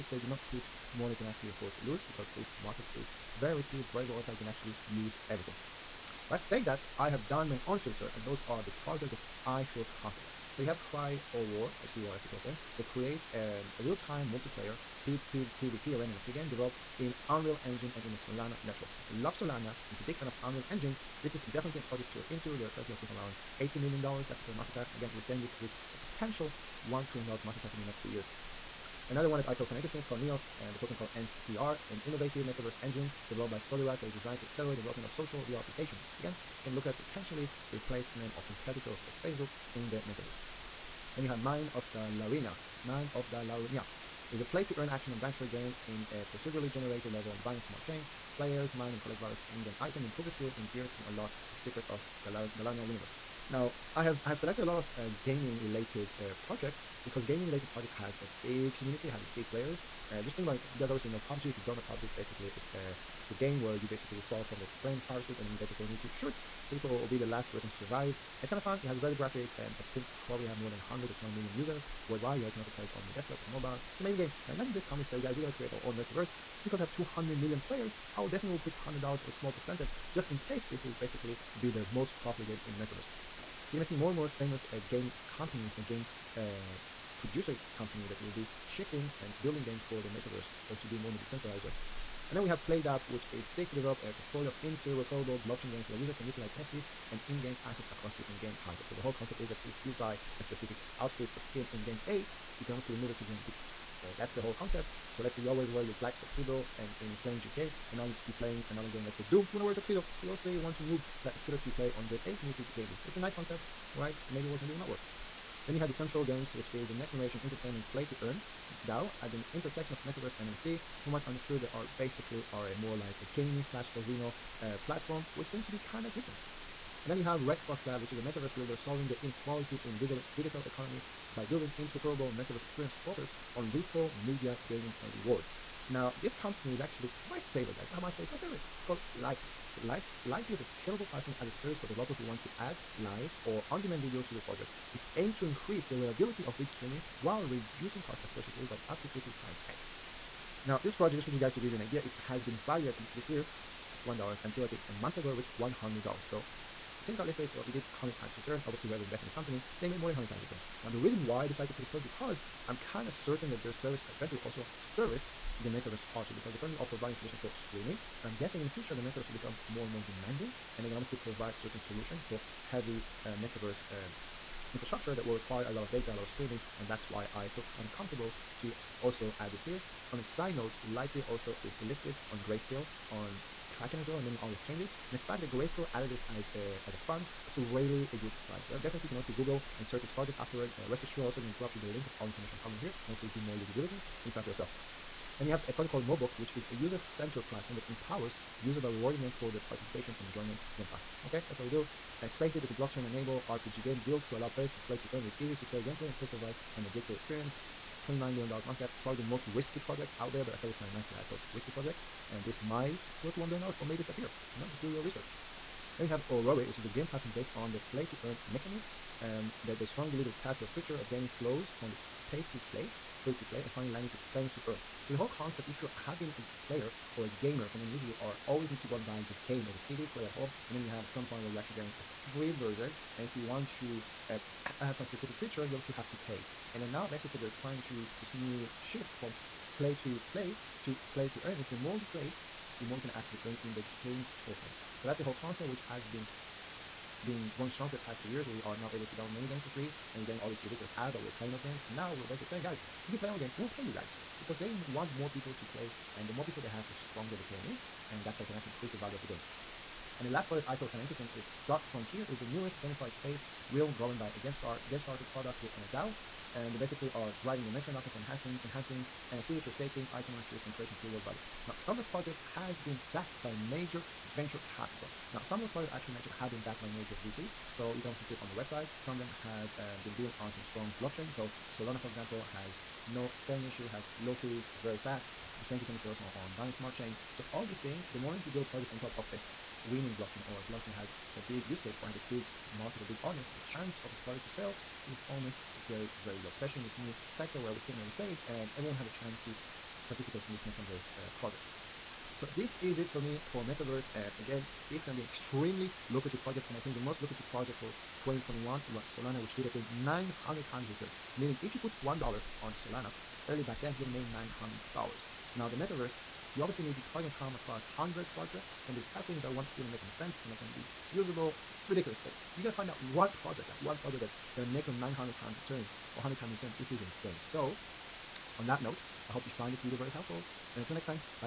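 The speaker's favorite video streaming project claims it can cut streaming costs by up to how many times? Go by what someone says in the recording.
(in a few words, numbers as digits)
50 times.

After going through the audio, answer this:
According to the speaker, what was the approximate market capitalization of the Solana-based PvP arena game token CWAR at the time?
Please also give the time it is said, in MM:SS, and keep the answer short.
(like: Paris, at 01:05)
$80 million, at 00:23.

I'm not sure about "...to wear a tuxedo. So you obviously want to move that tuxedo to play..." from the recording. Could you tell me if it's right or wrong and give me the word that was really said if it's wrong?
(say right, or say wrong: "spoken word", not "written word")
right.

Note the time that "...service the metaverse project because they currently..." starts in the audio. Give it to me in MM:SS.
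02:44.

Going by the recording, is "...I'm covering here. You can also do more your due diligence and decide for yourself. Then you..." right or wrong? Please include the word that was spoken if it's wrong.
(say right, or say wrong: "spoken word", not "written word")
right.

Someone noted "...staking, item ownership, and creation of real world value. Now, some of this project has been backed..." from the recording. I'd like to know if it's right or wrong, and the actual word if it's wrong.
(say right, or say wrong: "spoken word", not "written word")
right.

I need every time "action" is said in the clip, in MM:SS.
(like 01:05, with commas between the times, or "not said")
00:44.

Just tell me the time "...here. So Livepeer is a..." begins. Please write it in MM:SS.
02:19.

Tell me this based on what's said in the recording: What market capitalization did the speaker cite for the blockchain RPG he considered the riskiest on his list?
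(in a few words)
$29 million.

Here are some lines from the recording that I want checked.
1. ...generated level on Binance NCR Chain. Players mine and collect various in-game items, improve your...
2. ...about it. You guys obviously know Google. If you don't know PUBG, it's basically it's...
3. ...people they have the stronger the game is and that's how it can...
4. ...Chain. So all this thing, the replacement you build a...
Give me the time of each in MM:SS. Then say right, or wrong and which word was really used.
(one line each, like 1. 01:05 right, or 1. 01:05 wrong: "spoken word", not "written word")
1. 00:46 wrong: "Smart", not "NCR"
2. 01:00 wrong: "PUBG", not "Google"
3. 04:16 right
4. 04:46 wrong: "moment", not "replacement".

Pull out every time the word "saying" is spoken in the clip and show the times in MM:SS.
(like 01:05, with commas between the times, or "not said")
00:06, 00:25, 04:12.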